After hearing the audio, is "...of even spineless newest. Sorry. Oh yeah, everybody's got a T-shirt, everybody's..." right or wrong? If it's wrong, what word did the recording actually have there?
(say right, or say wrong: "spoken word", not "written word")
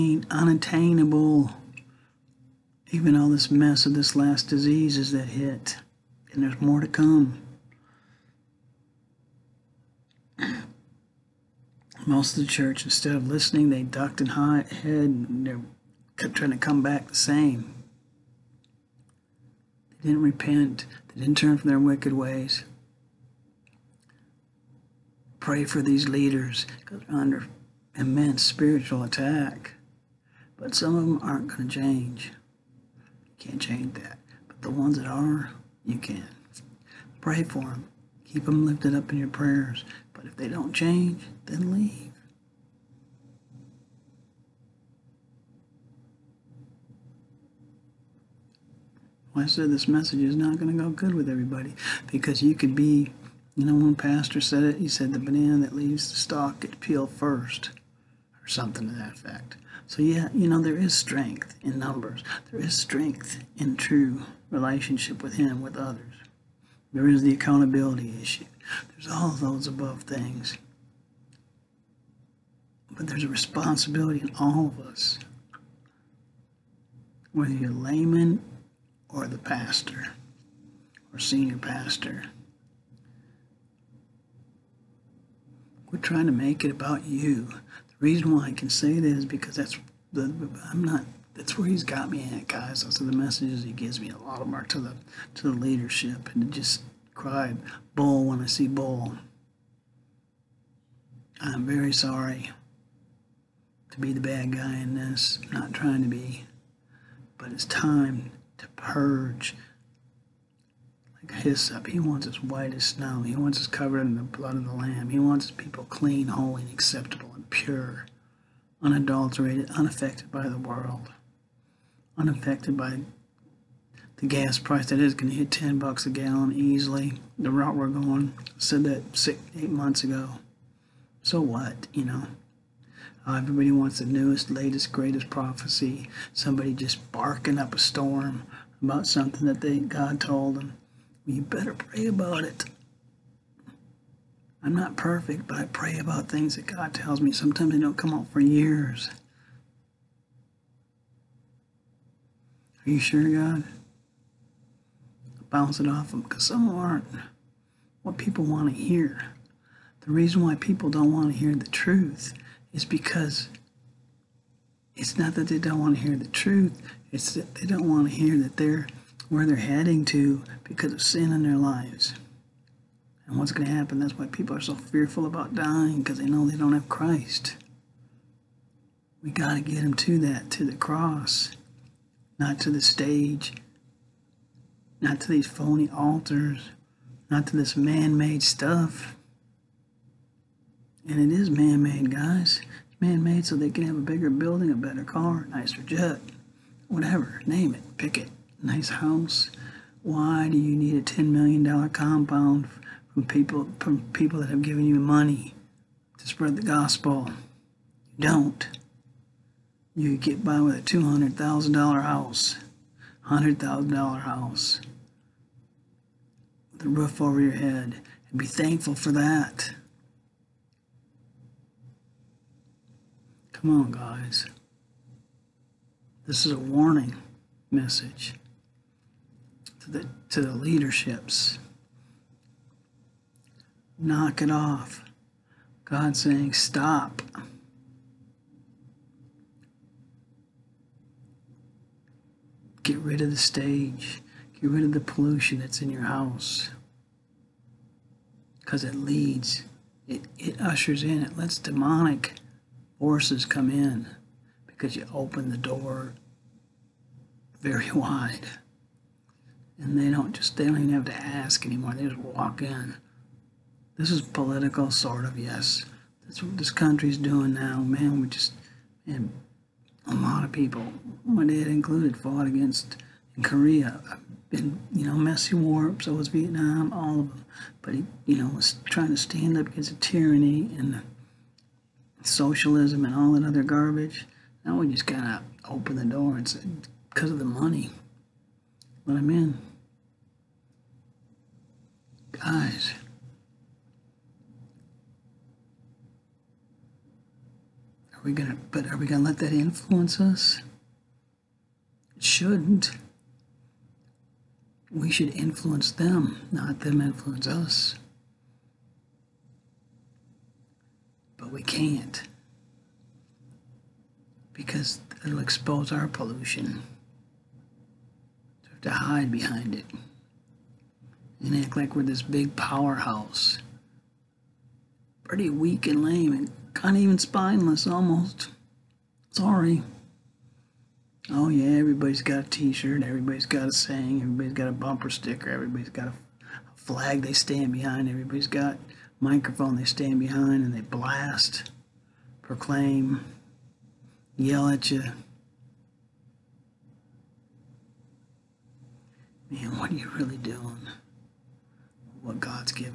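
wrong: "almost", not "newest".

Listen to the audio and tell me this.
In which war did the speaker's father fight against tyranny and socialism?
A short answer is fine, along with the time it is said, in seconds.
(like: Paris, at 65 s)
Korea, at 273 s.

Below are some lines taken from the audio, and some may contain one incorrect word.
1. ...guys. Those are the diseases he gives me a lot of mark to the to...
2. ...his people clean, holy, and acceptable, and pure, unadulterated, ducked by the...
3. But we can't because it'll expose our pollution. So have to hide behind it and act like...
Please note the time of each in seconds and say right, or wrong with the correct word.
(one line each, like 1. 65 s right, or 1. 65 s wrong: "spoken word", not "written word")
1. 92 s wrong: "messages", not "diseases"
2. 115 s wrong: "unaffected", not "ducked"
3. 311 s right.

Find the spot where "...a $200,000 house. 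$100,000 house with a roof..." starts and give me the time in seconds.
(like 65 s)
210 s.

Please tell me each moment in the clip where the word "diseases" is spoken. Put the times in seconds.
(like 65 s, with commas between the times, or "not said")
4 s.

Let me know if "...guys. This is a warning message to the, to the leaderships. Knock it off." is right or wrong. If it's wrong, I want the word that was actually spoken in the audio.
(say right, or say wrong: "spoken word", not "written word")
right.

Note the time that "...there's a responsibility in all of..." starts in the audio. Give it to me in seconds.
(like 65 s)
73 s.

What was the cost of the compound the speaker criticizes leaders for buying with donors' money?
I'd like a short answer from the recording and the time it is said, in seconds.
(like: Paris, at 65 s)
$10 million, at 201 s.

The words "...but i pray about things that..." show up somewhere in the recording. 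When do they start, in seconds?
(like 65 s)
145 s.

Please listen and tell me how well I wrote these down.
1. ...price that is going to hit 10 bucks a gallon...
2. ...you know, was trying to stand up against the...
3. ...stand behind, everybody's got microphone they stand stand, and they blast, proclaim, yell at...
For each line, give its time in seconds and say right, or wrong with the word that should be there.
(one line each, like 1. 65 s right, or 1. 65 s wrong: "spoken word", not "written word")
1. 124 s right
2. 278 s right
3. 337 s wrong: "behind", not "stand".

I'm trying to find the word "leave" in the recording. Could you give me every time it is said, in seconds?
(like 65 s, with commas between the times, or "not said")
41 s, 55 s.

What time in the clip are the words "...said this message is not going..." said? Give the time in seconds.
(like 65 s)
49 s.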